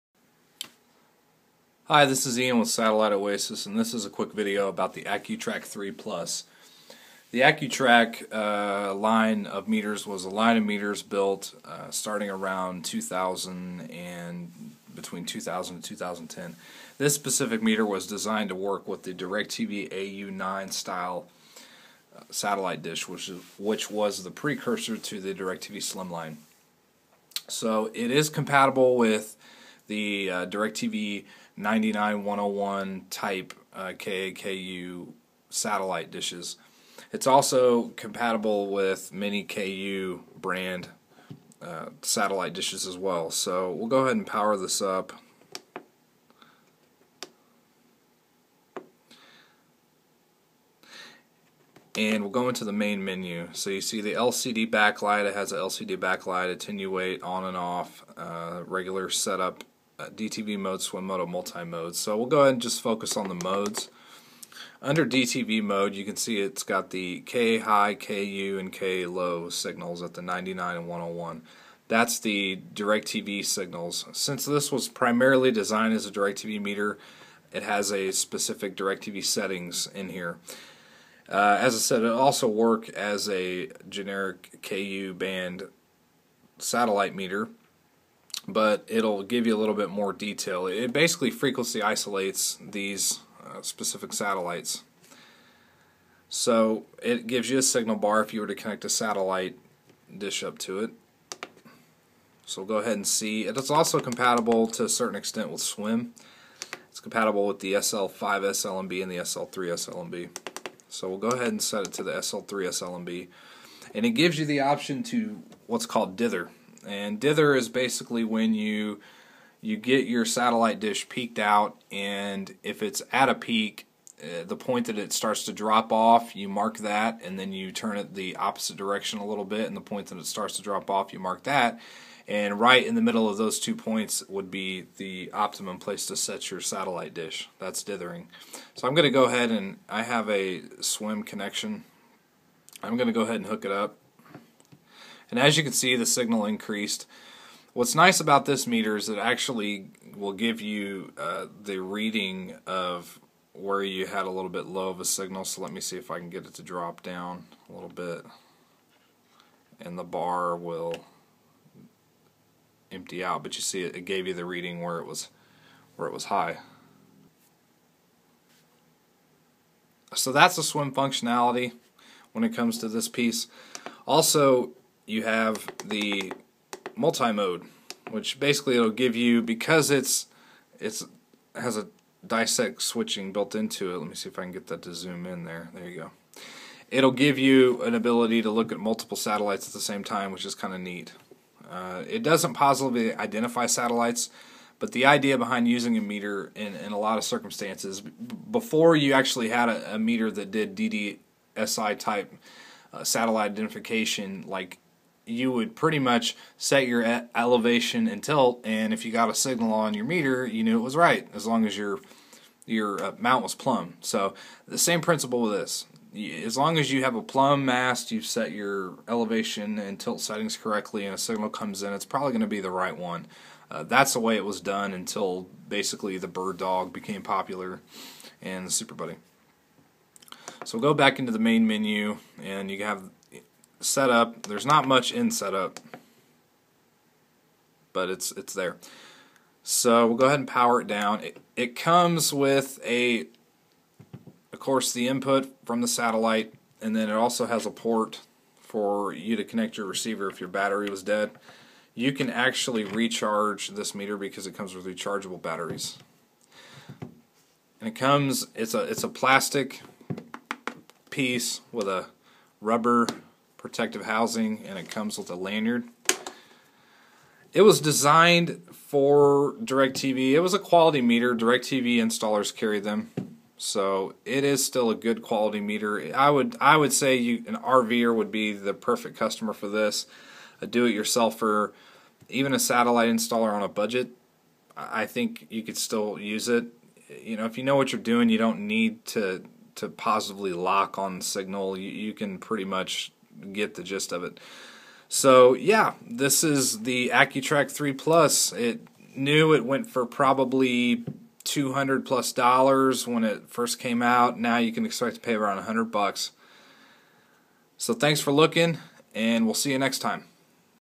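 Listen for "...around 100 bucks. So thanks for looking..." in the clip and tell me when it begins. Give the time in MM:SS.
05:05.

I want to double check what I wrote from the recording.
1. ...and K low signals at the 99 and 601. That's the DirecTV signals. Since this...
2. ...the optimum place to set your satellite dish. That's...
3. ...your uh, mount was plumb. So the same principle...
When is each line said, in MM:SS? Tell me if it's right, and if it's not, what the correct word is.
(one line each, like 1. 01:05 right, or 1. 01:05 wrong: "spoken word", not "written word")
1. 01:08 wrong: "101", not "601"
2. 02:14 right
3. 03:32 right.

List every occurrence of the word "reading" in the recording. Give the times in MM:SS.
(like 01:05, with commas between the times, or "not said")
02:31, 02:44.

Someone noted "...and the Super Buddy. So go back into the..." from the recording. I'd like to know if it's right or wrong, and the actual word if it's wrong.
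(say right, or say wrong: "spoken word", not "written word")
right.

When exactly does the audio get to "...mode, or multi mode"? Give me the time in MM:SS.
01:01.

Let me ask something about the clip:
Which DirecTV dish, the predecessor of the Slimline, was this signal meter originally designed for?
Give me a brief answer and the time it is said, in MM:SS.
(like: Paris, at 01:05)
AU9, at 00:19.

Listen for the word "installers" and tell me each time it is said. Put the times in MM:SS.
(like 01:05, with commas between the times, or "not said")
04:31, 04:43.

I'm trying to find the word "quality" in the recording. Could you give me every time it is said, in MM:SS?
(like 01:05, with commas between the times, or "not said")
04:30, 04:35.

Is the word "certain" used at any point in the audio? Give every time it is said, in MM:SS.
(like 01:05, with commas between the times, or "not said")
01:44.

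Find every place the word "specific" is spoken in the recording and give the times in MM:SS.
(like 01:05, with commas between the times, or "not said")
00:17, 01:18, 01:33.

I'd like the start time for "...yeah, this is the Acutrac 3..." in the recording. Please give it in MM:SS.
04:55.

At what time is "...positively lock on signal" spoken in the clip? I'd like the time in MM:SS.
04:49.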